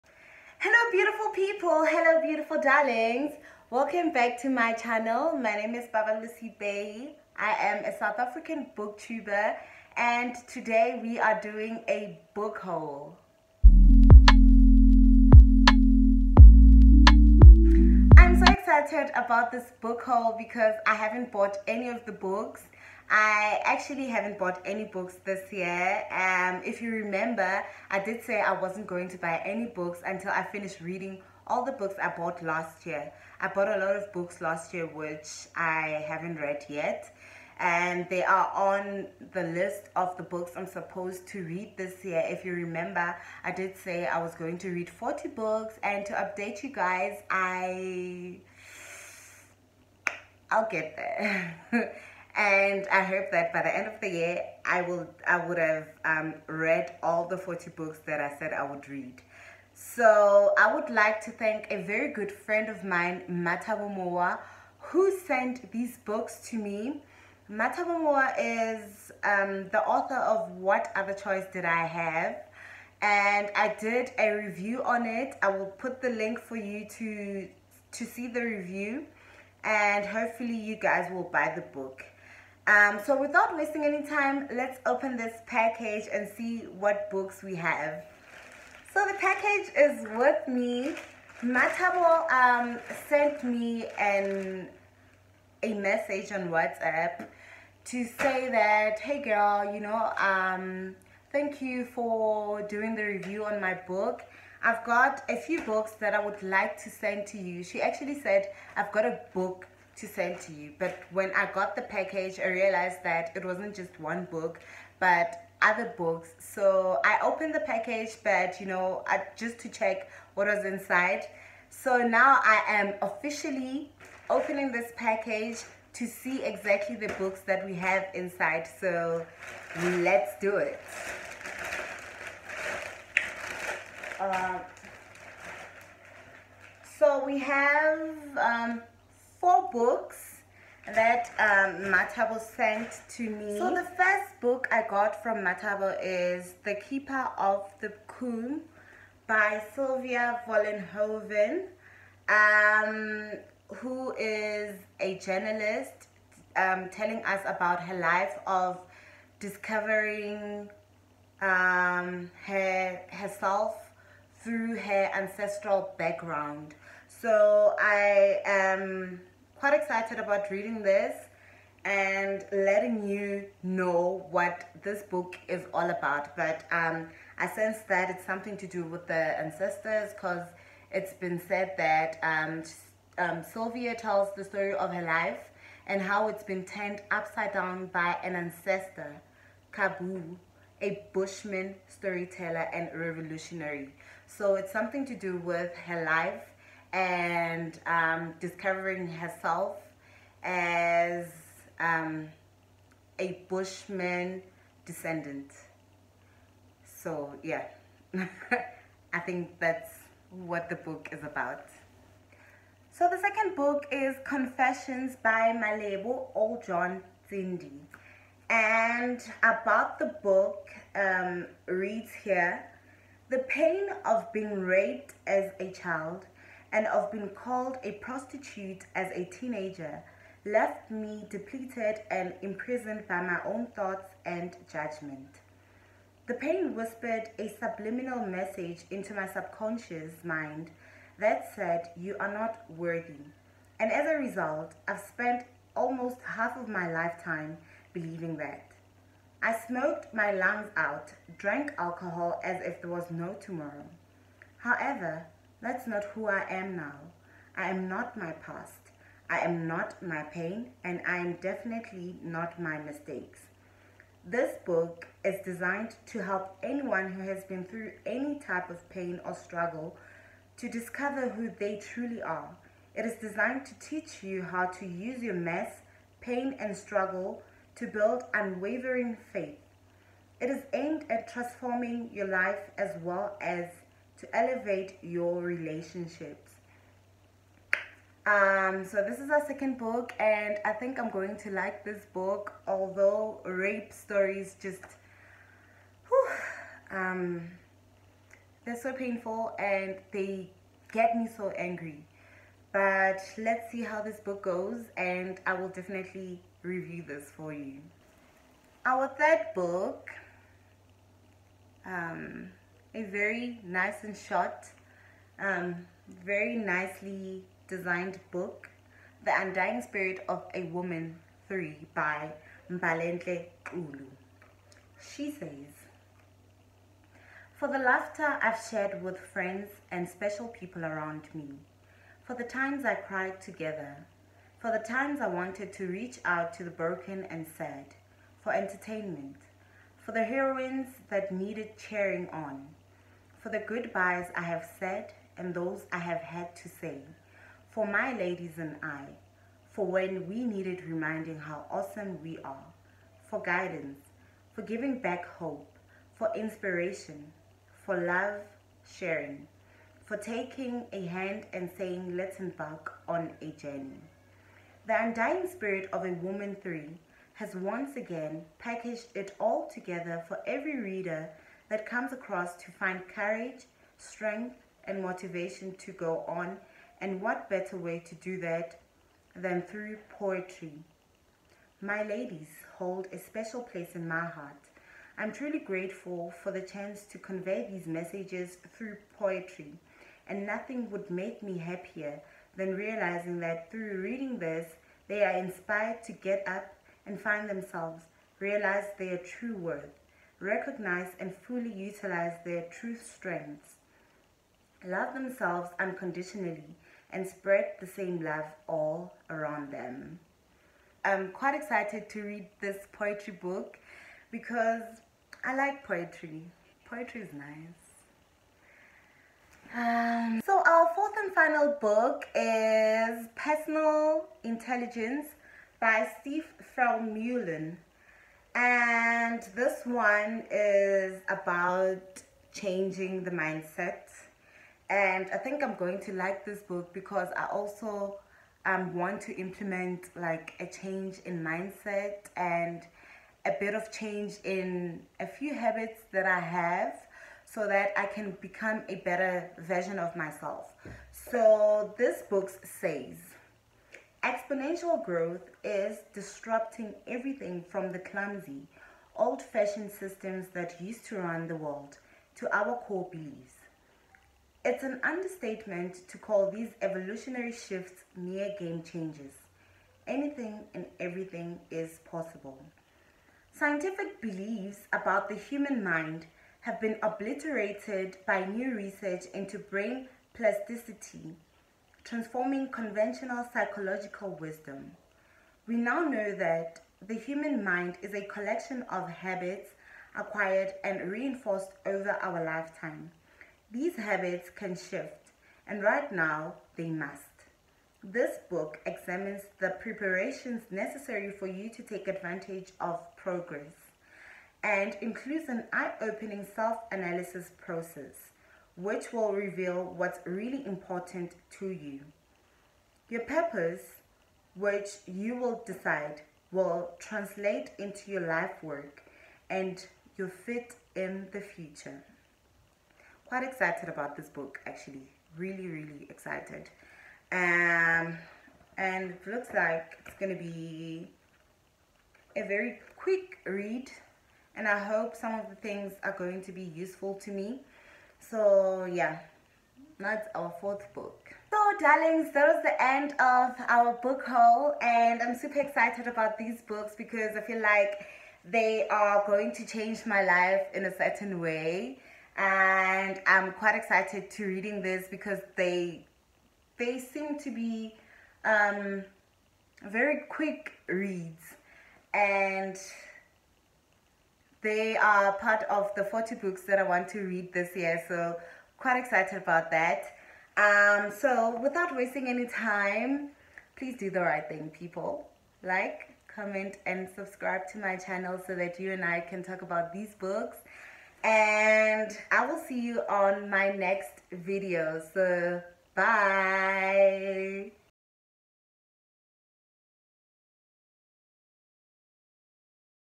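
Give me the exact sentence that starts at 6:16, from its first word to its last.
And what better way to do that than through poetry?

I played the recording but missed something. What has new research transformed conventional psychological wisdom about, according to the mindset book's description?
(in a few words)
brain plasticity.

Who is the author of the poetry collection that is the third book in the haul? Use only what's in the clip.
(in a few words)
Mbalentle Ulu.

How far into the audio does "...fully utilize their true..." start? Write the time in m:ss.
6:41.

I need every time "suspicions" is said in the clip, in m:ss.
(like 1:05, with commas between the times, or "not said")
not said.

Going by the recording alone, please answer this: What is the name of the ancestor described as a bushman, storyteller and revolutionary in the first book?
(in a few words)
Kabbo.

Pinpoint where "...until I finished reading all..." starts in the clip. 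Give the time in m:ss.
0:30.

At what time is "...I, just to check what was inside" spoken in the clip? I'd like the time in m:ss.
1:59.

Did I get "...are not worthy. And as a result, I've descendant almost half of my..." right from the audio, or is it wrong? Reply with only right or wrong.
wrong.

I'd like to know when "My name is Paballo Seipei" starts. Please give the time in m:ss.
0:05.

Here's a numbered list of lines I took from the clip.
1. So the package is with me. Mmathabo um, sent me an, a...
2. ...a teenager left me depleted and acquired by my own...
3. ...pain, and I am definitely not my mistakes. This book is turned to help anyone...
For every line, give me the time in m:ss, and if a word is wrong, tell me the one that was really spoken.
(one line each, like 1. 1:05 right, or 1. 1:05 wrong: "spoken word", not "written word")
1. 1:28 right
2. 3:49 wrong: "imprisoned", not "acquired"
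3. 4:20 wrong: "designed", not "turned".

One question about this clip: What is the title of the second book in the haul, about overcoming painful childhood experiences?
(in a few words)
Confessions.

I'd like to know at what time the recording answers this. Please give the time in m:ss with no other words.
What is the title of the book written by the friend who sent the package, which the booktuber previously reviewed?
1:10.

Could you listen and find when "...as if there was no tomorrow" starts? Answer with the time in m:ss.
4:12.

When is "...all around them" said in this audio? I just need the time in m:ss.
6:48.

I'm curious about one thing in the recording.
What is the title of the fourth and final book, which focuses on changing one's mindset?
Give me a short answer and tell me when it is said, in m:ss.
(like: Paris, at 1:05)
Personal Intelligence, at 7:03.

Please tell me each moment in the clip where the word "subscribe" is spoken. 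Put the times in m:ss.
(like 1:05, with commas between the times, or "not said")
9:37.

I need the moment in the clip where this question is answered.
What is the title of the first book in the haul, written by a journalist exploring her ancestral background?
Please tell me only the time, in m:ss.
2:26.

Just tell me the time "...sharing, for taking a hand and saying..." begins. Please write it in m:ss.
5:58.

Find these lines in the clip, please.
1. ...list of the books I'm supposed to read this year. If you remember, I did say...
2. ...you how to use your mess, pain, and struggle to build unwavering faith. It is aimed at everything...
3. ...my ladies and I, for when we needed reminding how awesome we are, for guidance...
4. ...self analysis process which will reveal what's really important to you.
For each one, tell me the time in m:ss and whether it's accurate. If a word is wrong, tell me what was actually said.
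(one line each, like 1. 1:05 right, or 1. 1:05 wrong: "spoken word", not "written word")
1. 0:39 right
2. 4:34 wrong: "transforming", not "everything"
3. 5:47 right
4. 8:26 right.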